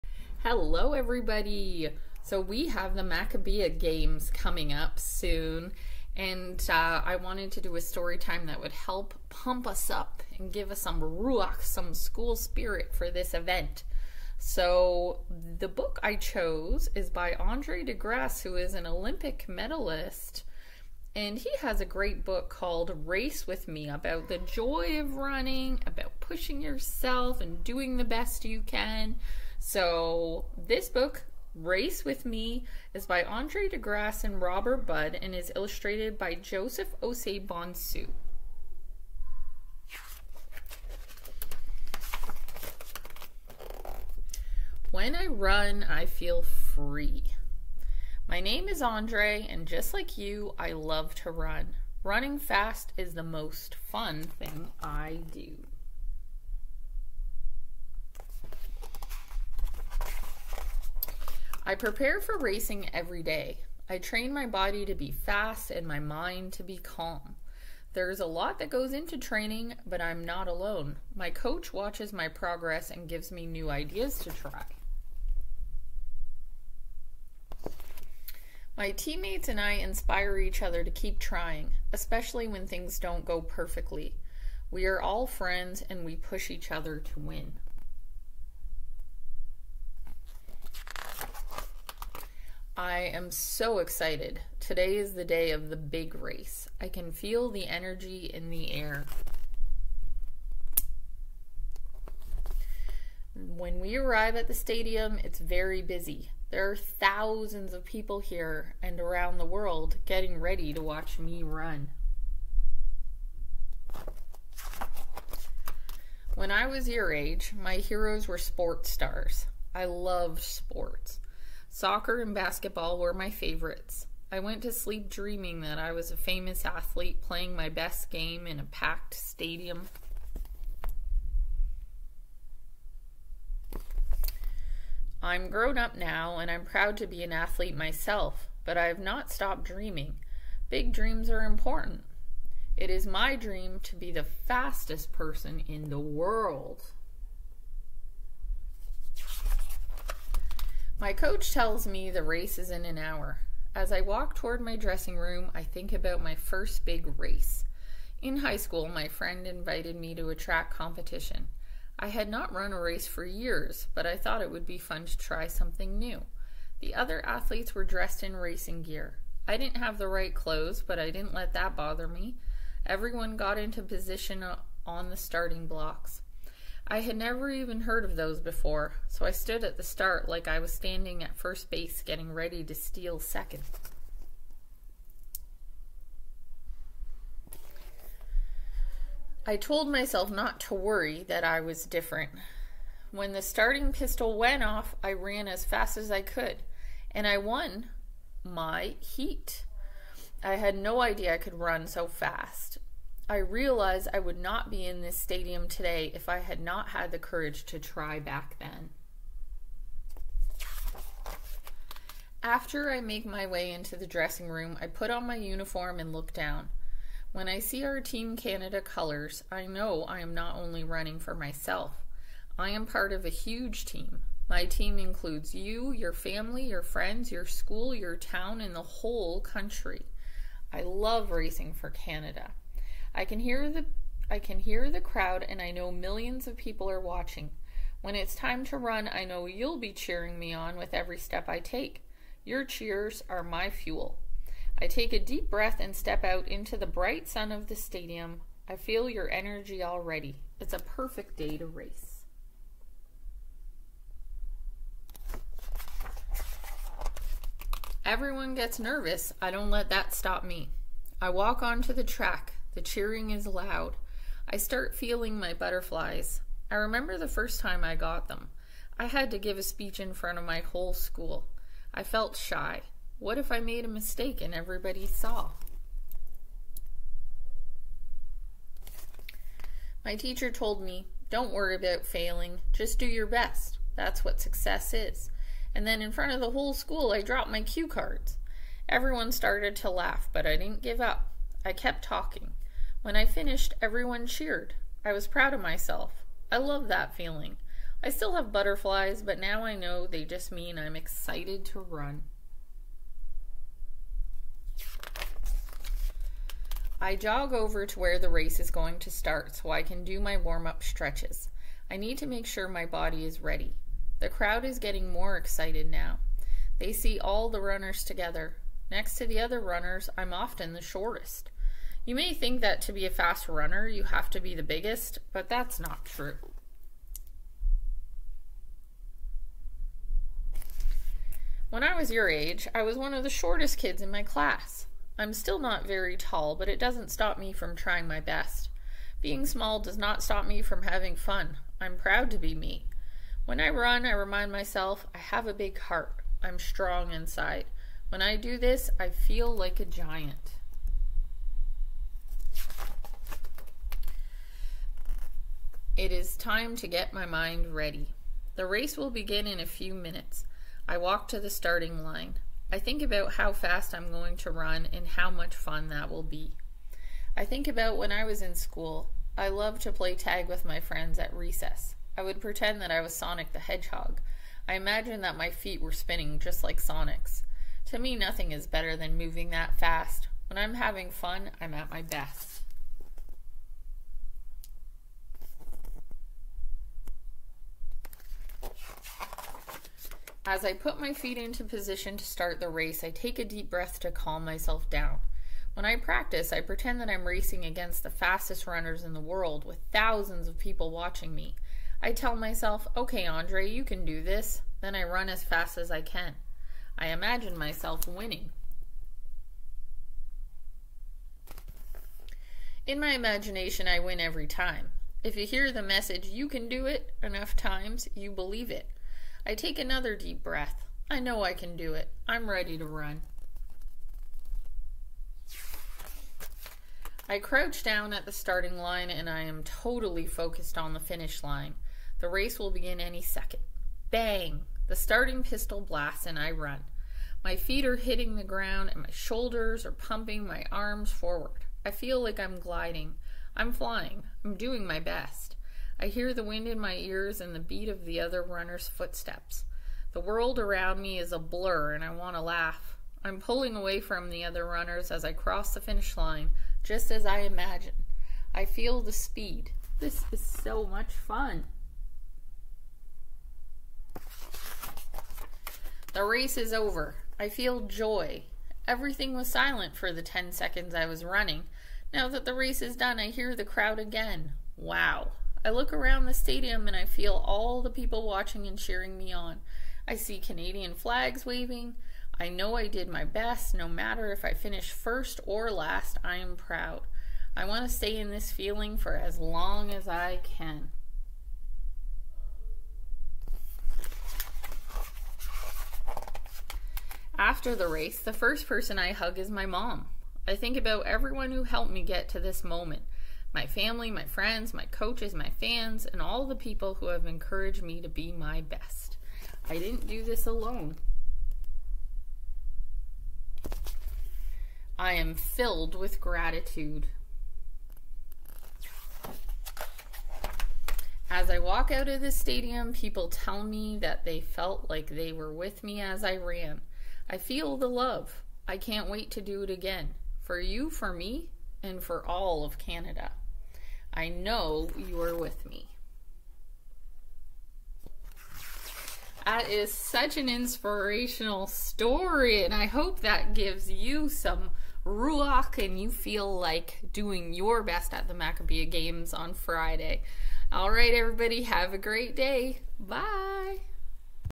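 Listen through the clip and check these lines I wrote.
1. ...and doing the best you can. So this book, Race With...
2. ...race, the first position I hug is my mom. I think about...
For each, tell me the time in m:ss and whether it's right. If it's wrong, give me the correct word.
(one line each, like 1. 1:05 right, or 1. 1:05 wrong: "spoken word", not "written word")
1. 0:27 right
2. 8:17 wrong: "person", not "position".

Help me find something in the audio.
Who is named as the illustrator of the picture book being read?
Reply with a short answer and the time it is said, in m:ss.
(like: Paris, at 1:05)
Joseph Osei Bonsu, at 0:36.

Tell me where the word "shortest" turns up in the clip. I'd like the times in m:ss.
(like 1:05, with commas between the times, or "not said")
5:20, 5:33.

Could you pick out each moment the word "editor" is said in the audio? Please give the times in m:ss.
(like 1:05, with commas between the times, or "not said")
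not said.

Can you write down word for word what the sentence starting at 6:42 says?
I tell myself, okay, Andre, you can do this.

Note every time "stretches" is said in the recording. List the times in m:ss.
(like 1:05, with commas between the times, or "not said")
5:10.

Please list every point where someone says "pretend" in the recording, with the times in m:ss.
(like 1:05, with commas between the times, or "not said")
6:12, 6:36.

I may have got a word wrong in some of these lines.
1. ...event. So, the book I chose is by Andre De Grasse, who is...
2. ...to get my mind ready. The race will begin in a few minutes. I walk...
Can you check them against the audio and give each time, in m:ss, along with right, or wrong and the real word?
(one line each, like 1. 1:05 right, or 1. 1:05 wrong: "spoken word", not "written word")
1. 0:13 right
2. 5:56 right.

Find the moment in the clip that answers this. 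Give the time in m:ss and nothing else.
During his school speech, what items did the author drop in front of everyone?
4:47.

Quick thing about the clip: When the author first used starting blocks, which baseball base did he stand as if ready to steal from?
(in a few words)
First base.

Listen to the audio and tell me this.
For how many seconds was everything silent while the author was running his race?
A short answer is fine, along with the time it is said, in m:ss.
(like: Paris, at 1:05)
10, at 7:50.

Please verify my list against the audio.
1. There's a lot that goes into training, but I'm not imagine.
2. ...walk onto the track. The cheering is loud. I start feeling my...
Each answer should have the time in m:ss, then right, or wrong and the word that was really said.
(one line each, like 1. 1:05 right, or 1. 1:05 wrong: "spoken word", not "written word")
1. 1:07 wrong: "alone", not "imagine"
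2. 4:21 right.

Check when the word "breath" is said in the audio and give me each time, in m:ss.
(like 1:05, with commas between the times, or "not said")
4:05, 6:33, 7:00.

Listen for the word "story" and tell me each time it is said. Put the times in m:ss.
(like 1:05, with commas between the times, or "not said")
0:07, 9:01.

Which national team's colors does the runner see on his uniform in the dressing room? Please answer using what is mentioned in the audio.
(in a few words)
Team Canada.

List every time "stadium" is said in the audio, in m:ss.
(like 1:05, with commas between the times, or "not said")
1:44, 2:09, 3:25, 4:07, 7:56, 8:42.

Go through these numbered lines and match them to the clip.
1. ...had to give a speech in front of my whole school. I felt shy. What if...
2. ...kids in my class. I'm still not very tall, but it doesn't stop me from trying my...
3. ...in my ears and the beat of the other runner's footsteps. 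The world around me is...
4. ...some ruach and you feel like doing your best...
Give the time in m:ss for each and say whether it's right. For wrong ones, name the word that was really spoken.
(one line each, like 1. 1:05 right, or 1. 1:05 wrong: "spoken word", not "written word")
1. 4:29 right
2. 5:33 right
3. 7:26 right
4. 9:04 right.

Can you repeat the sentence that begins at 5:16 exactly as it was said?
They see all the runners together.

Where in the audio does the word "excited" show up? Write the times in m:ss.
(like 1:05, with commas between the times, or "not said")
1:33, 5:00, 5:15.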